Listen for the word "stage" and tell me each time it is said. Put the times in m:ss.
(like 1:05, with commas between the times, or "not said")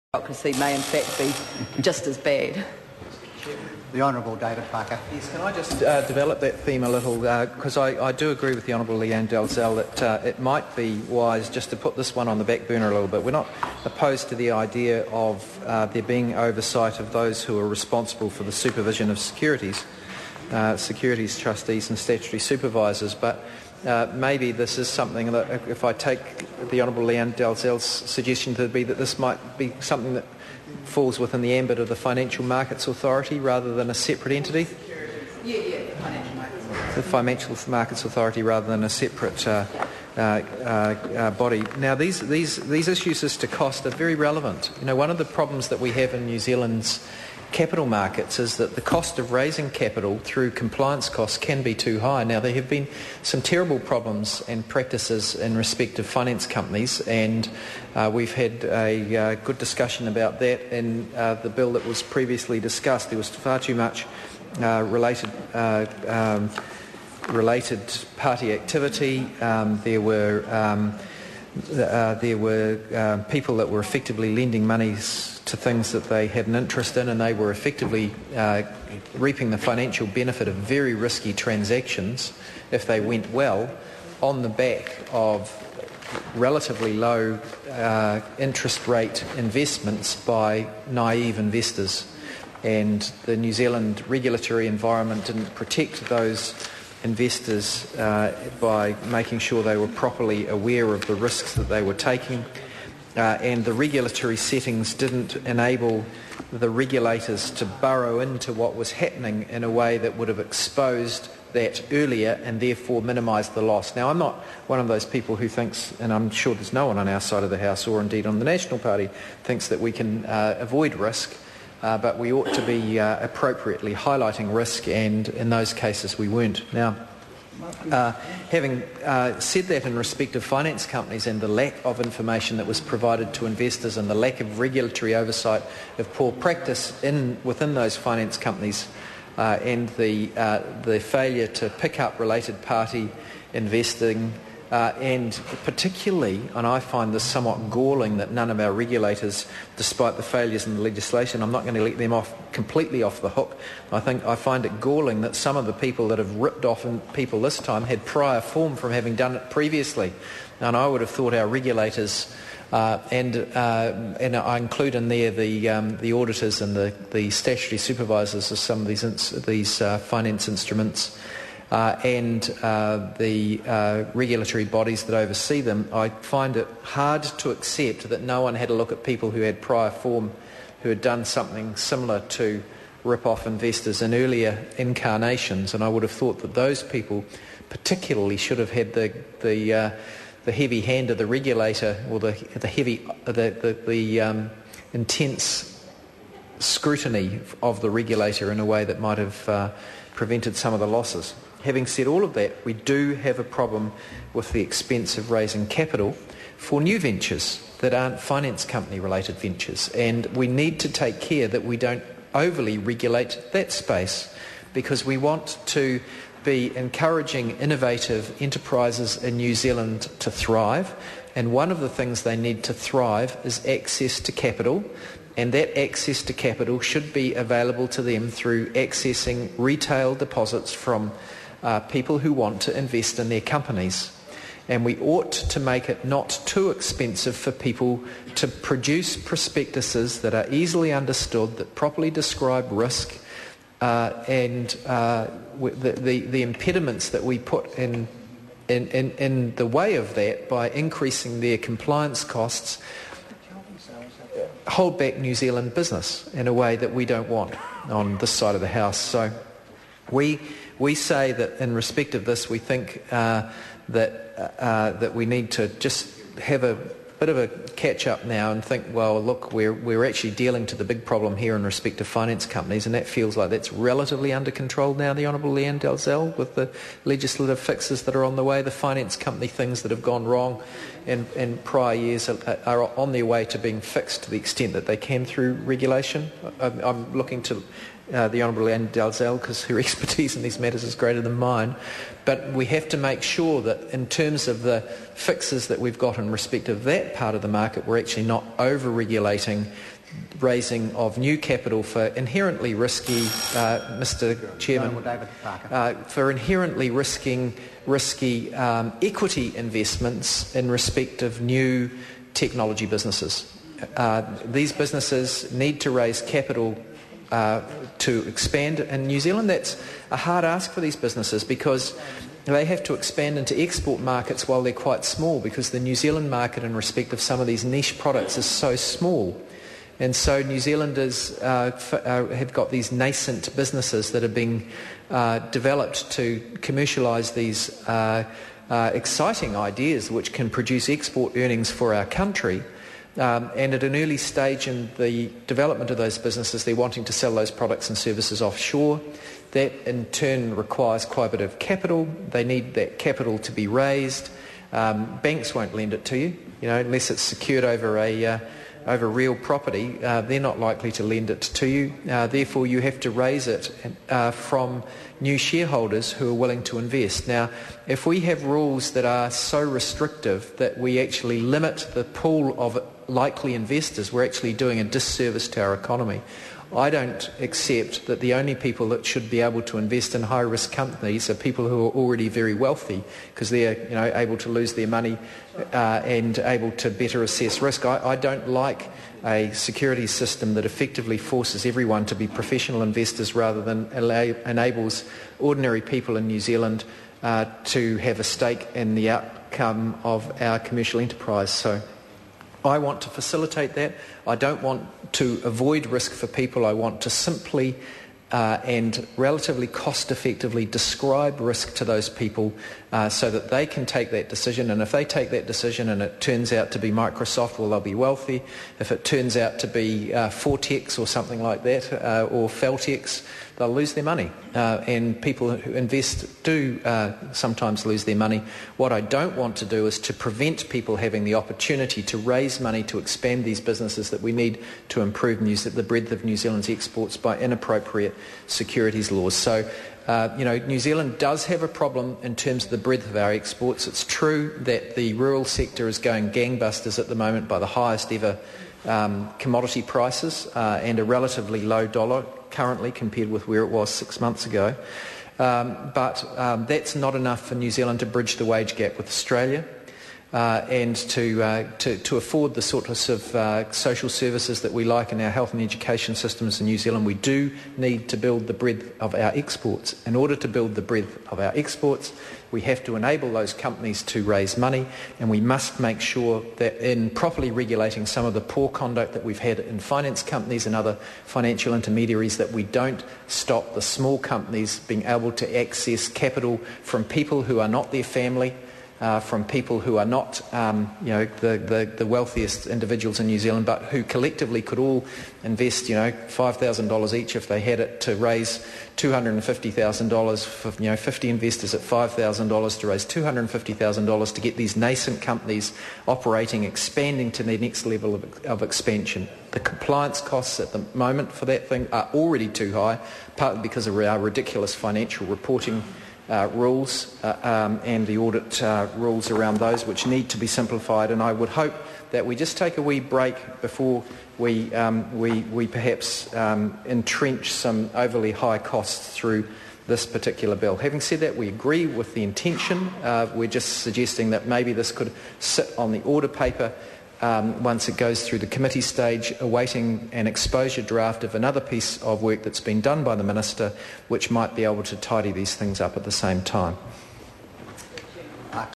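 5:44, 8:58.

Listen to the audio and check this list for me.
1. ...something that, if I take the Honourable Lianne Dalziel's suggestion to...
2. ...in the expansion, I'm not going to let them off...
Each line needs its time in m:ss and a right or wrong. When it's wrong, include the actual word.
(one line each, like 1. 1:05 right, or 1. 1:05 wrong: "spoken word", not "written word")
1. 0:24 right
2. 2:30 wrong: "legislation", not "expansion".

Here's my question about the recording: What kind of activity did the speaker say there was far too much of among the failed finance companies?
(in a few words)
related party activity.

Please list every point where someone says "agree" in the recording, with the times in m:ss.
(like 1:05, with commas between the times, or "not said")
0:08, 8:51.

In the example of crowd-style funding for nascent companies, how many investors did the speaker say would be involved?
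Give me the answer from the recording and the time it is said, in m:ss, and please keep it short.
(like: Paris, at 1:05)
50, at 8:20.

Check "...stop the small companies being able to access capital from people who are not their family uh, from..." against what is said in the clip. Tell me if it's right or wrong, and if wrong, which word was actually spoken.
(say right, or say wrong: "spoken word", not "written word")
right.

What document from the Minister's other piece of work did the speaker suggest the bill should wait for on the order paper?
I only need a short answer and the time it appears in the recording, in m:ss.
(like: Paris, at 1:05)
exposure draft, at 9:00.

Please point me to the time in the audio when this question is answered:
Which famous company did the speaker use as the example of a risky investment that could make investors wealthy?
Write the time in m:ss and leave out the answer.
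6:56.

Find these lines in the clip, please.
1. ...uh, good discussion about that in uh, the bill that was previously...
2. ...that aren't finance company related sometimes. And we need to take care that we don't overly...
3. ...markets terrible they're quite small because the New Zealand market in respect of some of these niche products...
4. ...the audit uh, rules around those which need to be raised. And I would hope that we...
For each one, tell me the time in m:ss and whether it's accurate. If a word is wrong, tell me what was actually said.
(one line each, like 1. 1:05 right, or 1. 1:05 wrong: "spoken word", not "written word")
1. 0:59 right
2. 3:27 wrong: "ventures", not "sometimes"
3. 5:24 wrong: "while", not "terrible"
4. 8:38 wrong: "simplified", not "raised".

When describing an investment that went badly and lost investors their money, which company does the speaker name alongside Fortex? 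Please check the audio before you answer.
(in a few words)
Feltex.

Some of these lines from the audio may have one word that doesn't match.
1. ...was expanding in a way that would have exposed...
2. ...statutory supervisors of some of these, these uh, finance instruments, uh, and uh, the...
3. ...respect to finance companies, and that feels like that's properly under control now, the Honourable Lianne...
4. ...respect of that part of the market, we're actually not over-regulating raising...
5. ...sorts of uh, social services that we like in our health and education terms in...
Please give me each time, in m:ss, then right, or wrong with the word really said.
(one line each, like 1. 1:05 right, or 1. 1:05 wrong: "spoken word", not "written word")
1. 1:48 wrong: "happening", not "expanding"
2. 2:47 right
3. 4:31 wrong: "relatively", not "properly"
4. 4:56 right
5. 7:42 wrong: "systems", not "terms".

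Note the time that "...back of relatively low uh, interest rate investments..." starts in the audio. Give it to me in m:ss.
1:24.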